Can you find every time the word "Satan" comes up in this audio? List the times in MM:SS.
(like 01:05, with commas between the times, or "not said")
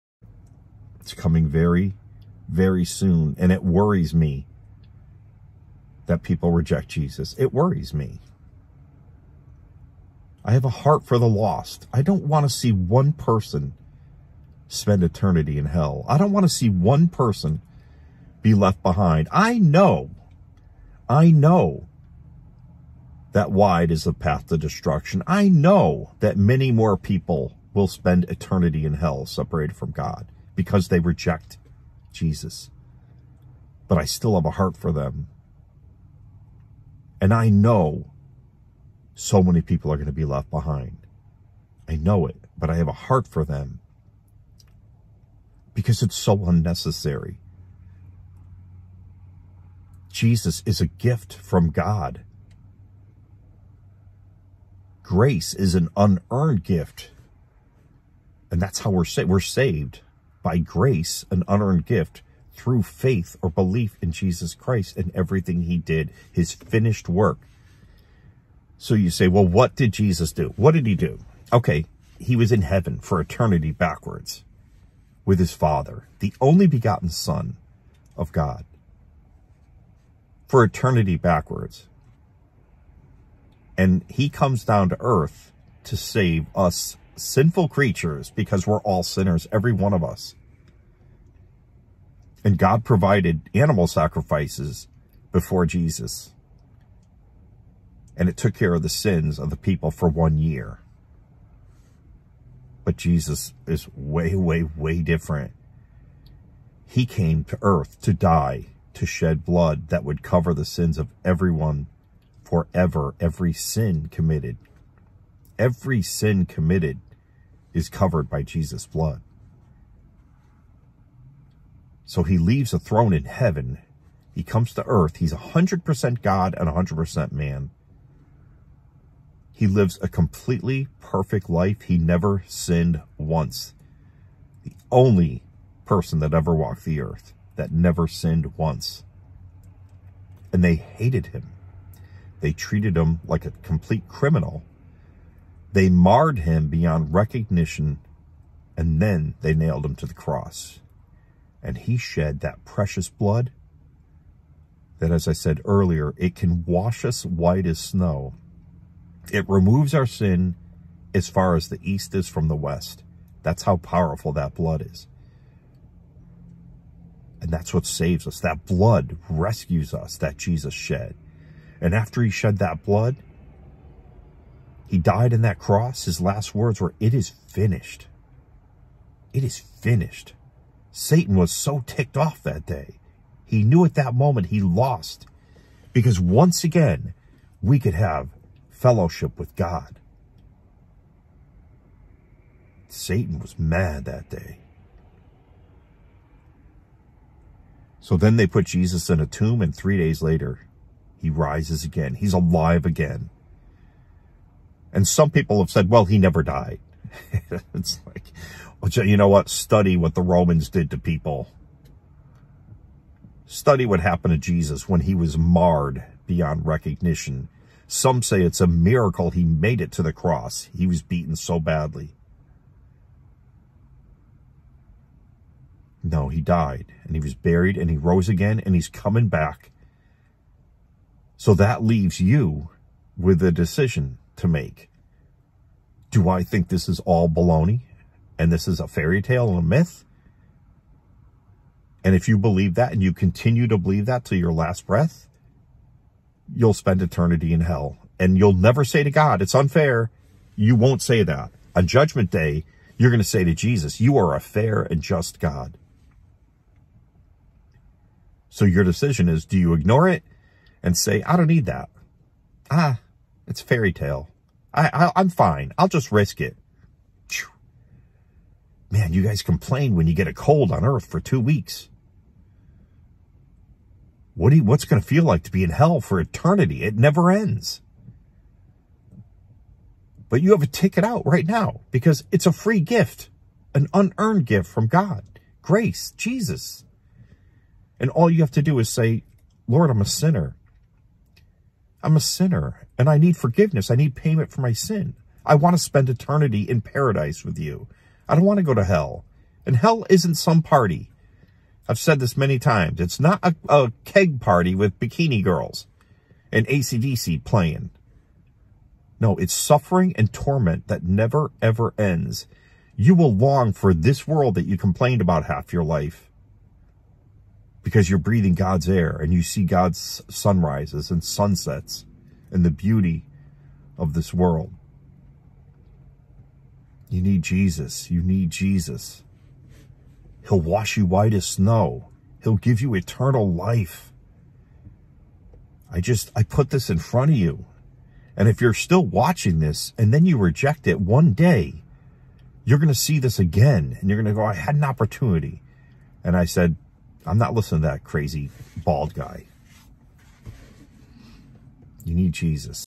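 03:00, 03:12.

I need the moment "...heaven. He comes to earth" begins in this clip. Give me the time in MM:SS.
02:03.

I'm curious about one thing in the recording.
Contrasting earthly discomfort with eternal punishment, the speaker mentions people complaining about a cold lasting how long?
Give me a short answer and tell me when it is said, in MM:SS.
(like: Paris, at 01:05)
2 weeks, at 04:31.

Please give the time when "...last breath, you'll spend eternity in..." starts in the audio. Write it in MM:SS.
04:04.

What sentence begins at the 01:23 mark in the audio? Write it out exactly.
And he comes down to earth to save us sinful creatures because we're all sinners, every one of us.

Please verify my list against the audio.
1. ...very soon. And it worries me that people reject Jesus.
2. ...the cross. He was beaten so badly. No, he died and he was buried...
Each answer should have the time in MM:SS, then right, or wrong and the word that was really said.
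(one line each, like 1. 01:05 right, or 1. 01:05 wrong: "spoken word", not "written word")
1. 00:02 right
2. 03:40 right.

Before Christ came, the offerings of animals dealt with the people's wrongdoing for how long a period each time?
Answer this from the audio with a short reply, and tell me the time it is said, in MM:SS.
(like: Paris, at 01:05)
1 year, at 01:40.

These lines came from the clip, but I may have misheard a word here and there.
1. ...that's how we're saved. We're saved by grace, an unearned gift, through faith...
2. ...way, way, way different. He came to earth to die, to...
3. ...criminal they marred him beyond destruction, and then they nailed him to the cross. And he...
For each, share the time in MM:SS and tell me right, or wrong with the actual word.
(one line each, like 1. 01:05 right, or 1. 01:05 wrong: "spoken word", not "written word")
1. 00:58 right
2. 01:43 right
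3. 02:24 wrong: "recognition", not "destruction".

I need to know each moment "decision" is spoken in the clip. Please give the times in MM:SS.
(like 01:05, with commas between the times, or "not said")
03:53, 04:18.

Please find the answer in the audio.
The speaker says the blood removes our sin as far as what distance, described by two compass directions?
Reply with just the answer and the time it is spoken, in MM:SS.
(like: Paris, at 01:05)
As far as the east is from the west, at 02:41.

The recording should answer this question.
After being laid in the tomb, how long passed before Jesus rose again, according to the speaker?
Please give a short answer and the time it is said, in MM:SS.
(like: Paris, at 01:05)
3 days, at 03:19.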